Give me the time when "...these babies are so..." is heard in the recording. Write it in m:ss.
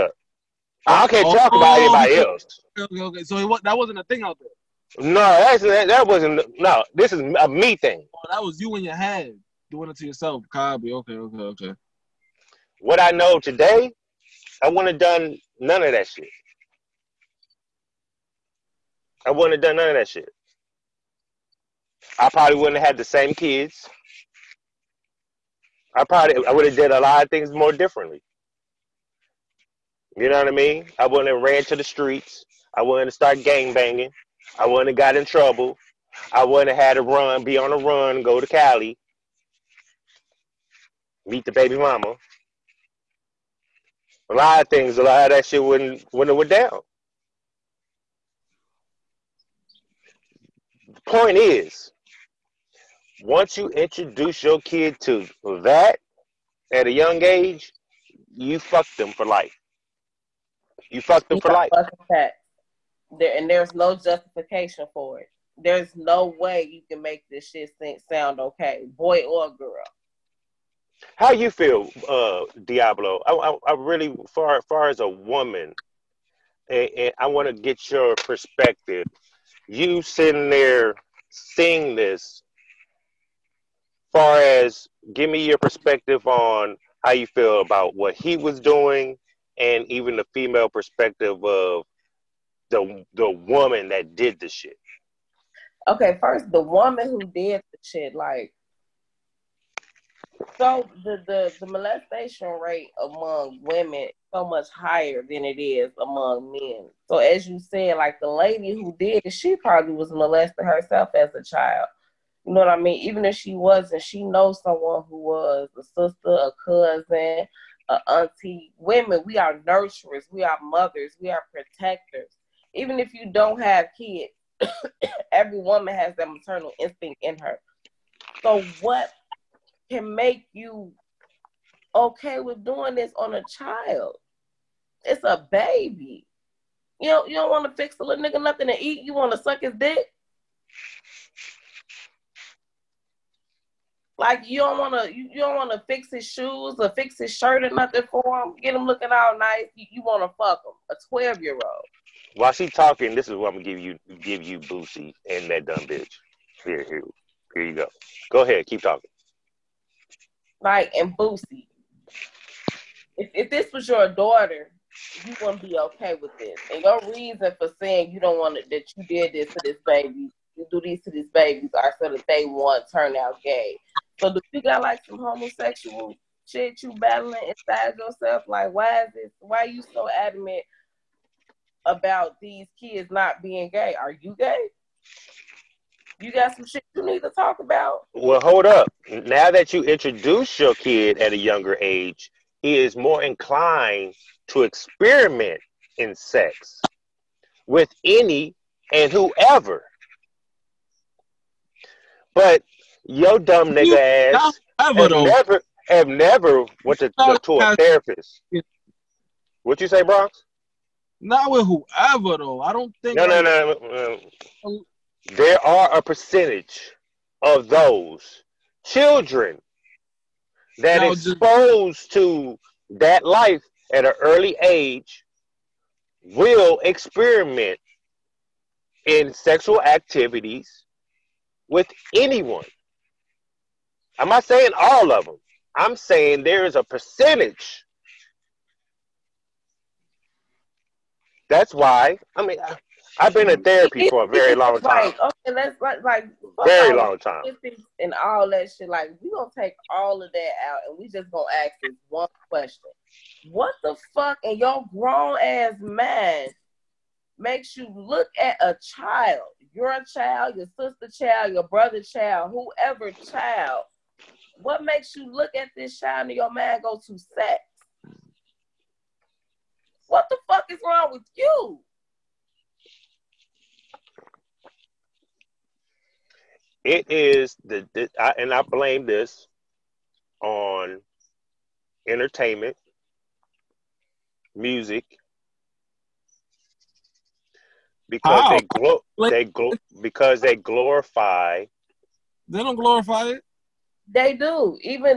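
2:51.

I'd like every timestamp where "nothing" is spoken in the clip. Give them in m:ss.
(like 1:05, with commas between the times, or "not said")
2:18, 2:27.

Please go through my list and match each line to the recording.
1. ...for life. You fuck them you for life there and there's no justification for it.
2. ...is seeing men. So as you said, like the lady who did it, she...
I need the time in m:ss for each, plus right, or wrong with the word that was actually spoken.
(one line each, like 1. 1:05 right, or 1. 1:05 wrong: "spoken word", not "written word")
1. 0:59 right
2. 1:45 wrong: "among", not "seeing".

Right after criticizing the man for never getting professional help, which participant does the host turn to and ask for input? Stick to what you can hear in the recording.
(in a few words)
Bronx.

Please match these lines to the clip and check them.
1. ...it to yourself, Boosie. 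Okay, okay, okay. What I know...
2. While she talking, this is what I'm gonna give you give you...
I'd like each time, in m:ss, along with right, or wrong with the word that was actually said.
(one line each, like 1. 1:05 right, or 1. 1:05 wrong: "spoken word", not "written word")
1. 0:09 wrong: "Cosby", not "Boosie"
2. 2:32 right.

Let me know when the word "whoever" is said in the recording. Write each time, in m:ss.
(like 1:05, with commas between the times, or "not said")
3:19, 3:31, 4:22.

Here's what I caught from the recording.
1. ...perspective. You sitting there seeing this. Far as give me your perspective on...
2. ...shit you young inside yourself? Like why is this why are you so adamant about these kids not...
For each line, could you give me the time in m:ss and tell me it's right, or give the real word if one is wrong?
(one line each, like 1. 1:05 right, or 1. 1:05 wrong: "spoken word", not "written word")
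1. 1:18 right
2. 2:56 wrong: "battling", not "young".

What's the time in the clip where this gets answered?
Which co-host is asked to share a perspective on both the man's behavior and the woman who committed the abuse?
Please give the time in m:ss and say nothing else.
1:12.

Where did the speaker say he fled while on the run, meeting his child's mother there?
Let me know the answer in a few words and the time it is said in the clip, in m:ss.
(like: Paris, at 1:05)
Cali, at 0:38.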